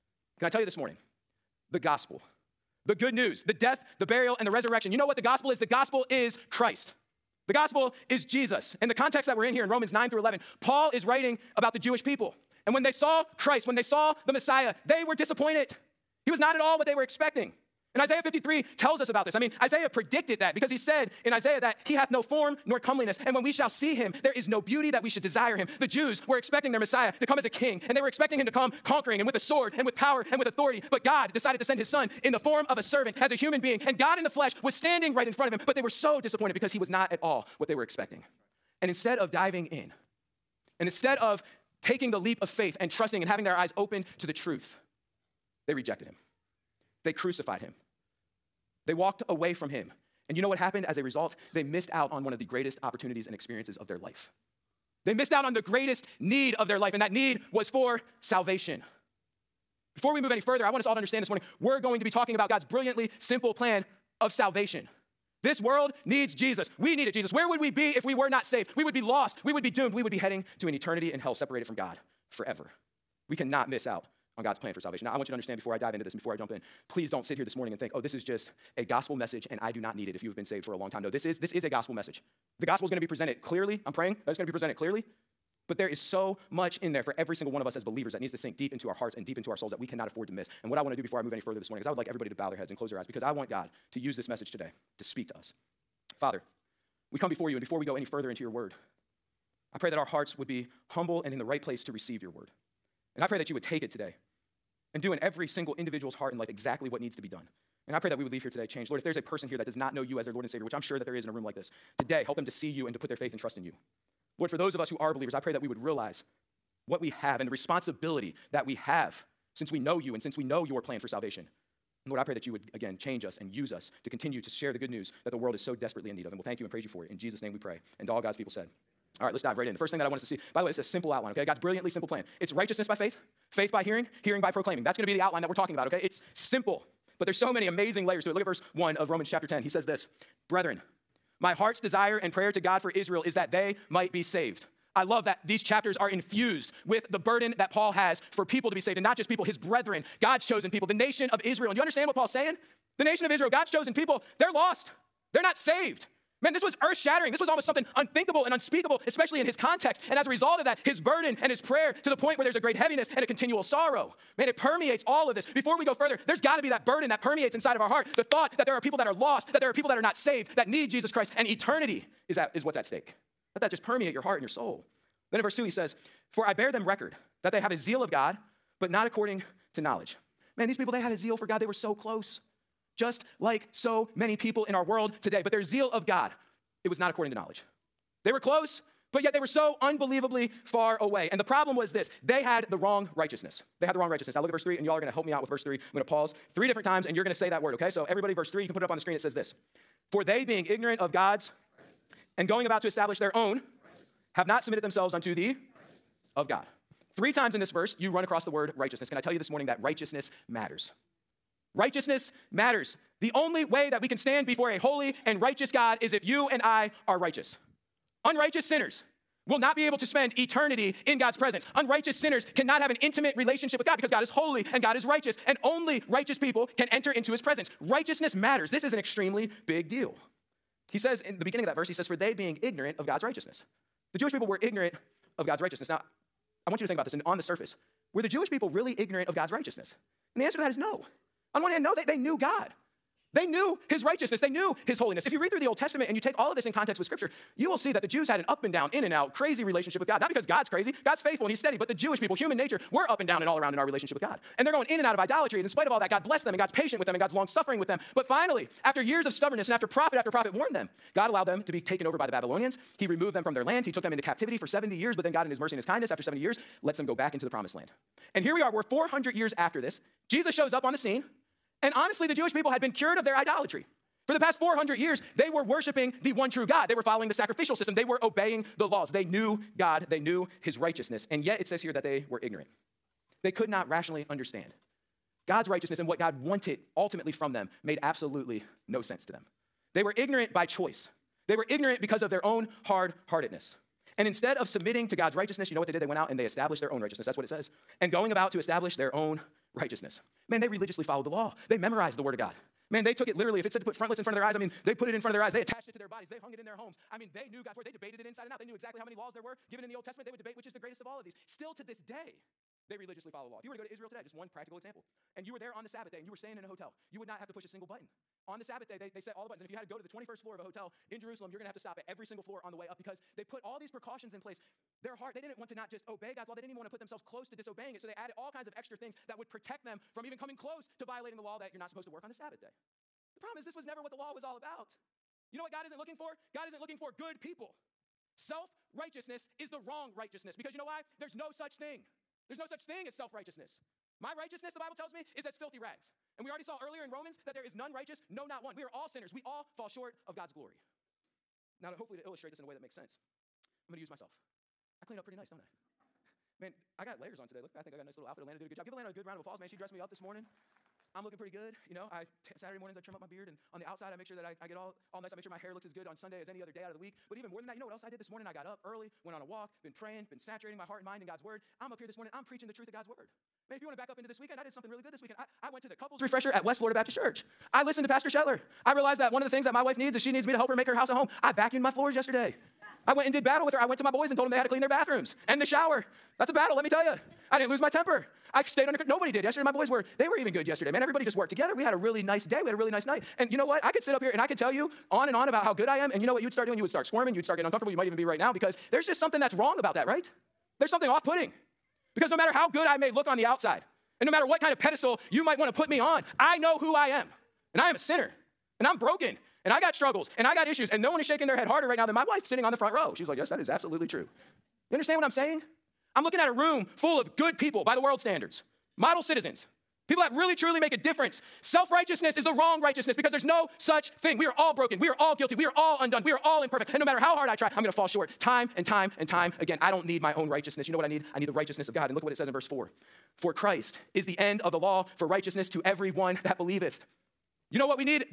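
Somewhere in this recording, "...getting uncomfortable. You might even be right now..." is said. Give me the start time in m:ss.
6:37.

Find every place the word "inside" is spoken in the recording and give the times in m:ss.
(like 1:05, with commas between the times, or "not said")
2:47, 5:08.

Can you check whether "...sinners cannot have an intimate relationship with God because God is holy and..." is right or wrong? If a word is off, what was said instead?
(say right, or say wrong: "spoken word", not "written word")
right.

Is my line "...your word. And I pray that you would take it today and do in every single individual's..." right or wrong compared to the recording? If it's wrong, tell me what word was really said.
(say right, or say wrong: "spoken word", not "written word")
right.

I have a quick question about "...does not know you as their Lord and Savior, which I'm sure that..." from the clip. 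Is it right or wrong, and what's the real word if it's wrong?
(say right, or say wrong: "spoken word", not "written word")
right.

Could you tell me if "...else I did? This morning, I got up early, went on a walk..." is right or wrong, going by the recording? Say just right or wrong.
right.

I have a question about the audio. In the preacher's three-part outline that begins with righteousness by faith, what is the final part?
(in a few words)
Hearing by proclaiming.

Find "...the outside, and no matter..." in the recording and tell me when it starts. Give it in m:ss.
6:43.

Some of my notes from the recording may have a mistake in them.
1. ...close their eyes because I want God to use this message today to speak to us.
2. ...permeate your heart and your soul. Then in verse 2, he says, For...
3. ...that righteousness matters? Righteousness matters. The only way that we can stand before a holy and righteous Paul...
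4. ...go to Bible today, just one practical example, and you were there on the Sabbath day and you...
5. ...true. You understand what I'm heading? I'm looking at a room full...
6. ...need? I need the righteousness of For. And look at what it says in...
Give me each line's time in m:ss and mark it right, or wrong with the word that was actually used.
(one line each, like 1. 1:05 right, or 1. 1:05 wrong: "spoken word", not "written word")
1. 1:32 right
2. 2:53 right
3. 3:29 wrong: "God", not "Paul"
4. 5:13 wrong: "Israel", not "Bible"
5. 6:54 wrong: "saying", not "heading"
6. 7:11 wrong: "God", not "For".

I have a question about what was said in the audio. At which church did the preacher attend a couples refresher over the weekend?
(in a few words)
West Florida Baptist Church.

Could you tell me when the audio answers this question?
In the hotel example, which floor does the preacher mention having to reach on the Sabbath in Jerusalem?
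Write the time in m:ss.
5:20.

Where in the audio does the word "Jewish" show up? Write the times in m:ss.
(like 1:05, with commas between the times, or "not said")
0:11, 3:54, 3:58, 4:11, 4:32.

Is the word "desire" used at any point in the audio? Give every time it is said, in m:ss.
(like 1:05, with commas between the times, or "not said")
0:25, 2:21.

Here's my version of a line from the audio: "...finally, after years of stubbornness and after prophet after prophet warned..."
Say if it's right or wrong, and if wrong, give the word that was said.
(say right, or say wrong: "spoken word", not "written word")
right.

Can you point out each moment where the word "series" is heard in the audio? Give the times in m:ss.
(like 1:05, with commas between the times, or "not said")
not said.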